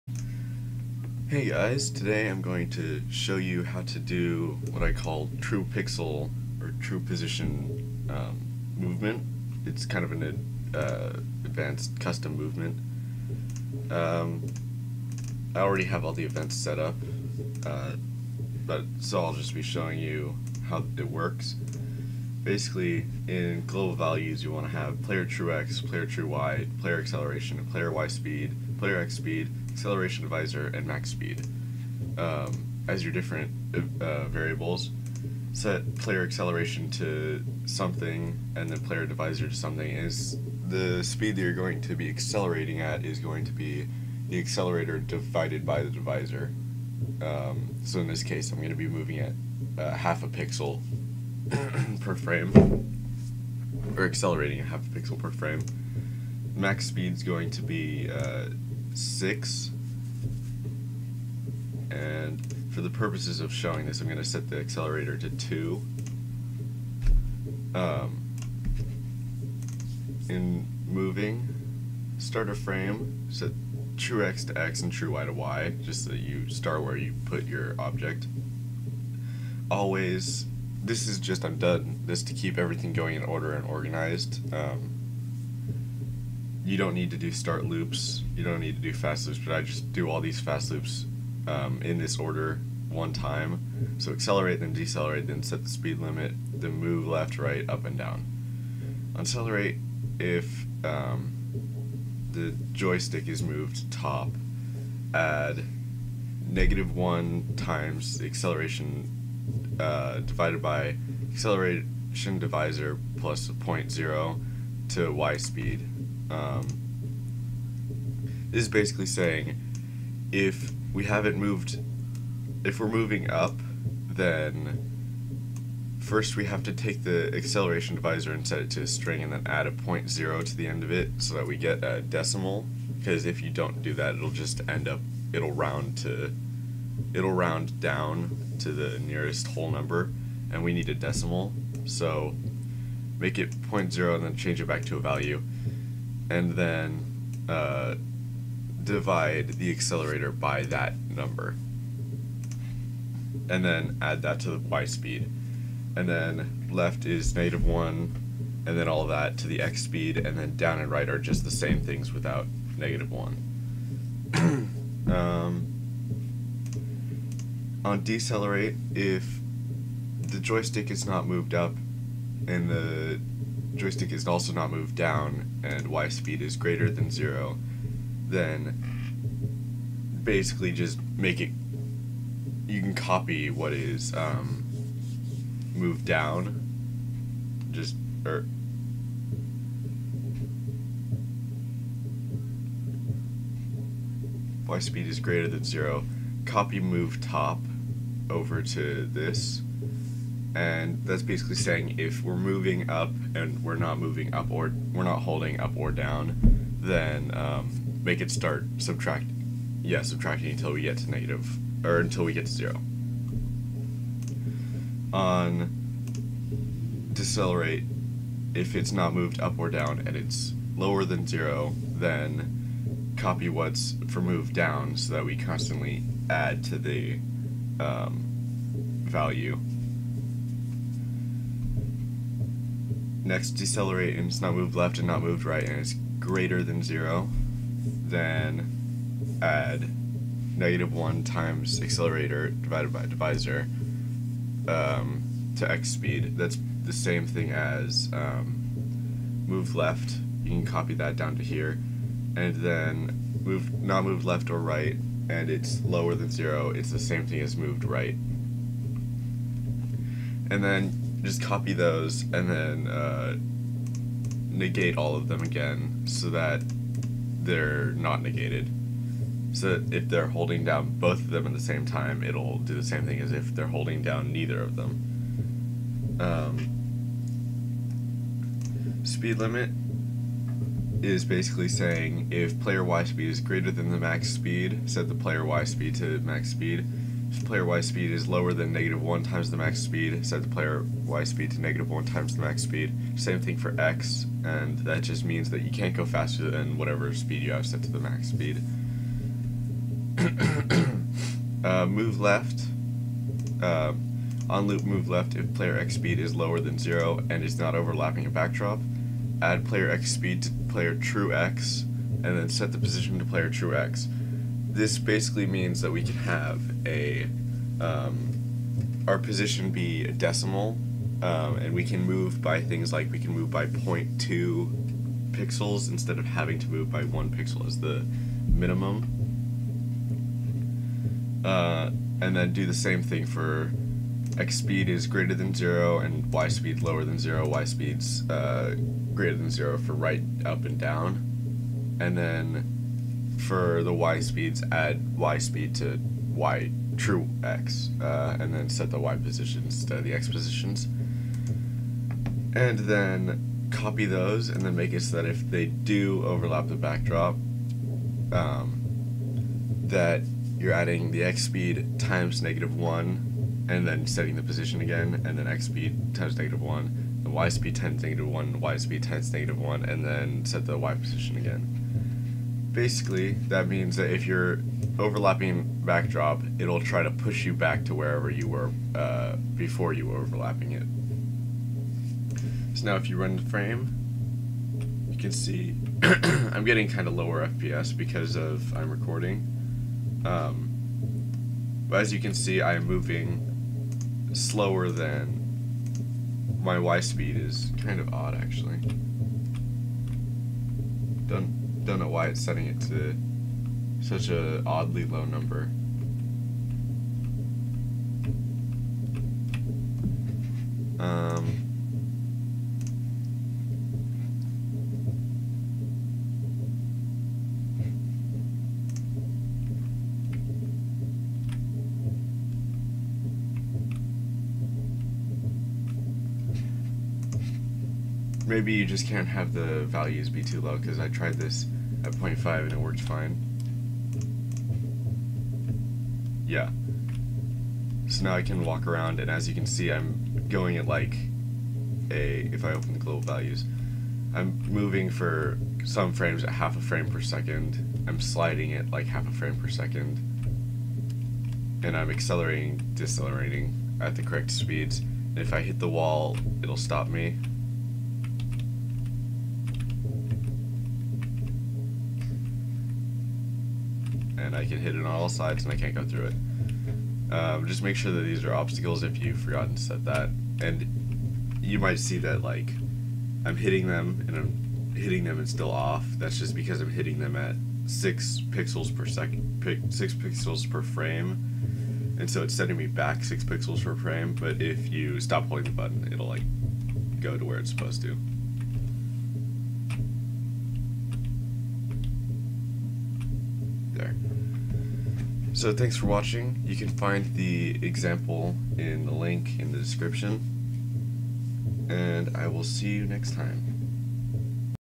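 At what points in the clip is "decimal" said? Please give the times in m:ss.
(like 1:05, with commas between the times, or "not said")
2:12, 2:20, 5:20.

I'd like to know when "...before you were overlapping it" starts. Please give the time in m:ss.
6:19.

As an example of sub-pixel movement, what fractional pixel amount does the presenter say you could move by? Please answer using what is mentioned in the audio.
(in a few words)
0.2 pixels.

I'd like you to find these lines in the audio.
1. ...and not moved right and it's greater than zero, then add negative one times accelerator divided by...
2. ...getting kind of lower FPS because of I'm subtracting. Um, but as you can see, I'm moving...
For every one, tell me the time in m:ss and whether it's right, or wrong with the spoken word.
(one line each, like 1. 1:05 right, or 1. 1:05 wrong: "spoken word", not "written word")
1. 3:54 right
2. 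6:26 wrong: "recording", not "subtracting".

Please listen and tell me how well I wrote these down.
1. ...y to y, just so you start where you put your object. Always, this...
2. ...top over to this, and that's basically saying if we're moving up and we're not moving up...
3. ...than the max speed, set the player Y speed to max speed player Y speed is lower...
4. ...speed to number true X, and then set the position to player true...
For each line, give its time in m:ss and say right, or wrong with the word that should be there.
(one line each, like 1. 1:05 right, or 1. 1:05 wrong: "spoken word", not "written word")
1. 1:15 right
2. 3:17 right
3. 4:43 right
4. 5:10 wrong: "player", not "number".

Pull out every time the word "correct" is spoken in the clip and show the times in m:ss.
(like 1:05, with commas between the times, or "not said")
7:34.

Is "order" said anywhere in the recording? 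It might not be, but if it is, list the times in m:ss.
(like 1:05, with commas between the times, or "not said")
1:23, 1:32.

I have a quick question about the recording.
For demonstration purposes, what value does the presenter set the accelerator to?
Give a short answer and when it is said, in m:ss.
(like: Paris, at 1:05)
2, at 1:05.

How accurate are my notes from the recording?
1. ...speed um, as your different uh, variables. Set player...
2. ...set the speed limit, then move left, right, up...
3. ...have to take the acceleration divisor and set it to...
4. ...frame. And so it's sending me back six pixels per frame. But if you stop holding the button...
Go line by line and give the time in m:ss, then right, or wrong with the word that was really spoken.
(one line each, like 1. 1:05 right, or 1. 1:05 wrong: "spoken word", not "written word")
1. 0:31 right
2. 1:35 right
3. 2:06 right
4. 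8:00 right.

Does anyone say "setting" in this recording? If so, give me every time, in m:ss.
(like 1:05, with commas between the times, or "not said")
6:04, 6:42.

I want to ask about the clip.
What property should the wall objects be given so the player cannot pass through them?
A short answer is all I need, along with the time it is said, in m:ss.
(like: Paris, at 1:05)
obstacles, at 7:48.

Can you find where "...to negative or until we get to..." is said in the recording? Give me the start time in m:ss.
3:30.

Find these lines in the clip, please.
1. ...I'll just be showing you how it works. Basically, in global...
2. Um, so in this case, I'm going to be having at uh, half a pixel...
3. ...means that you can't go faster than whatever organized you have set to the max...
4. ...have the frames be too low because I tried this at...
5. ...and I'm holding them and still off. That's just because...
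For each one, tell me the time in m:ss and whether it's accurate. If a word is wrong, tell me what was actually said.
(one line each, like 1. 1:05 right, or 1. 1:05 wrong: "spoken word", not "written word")
1. 0:19 right
2. 0:47 wrong: "moving", not "having"
3. 4:55 wrong: "speed", not "organized"
4. 7:09 wrong: "values", not "frames"
5. 7:54 wrong: "hitting", not "holding".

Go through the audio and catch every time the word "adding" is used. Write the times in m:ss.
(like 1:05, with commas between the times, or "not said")
6:00.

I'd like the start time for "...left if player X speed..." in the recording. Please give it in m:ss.
5:05.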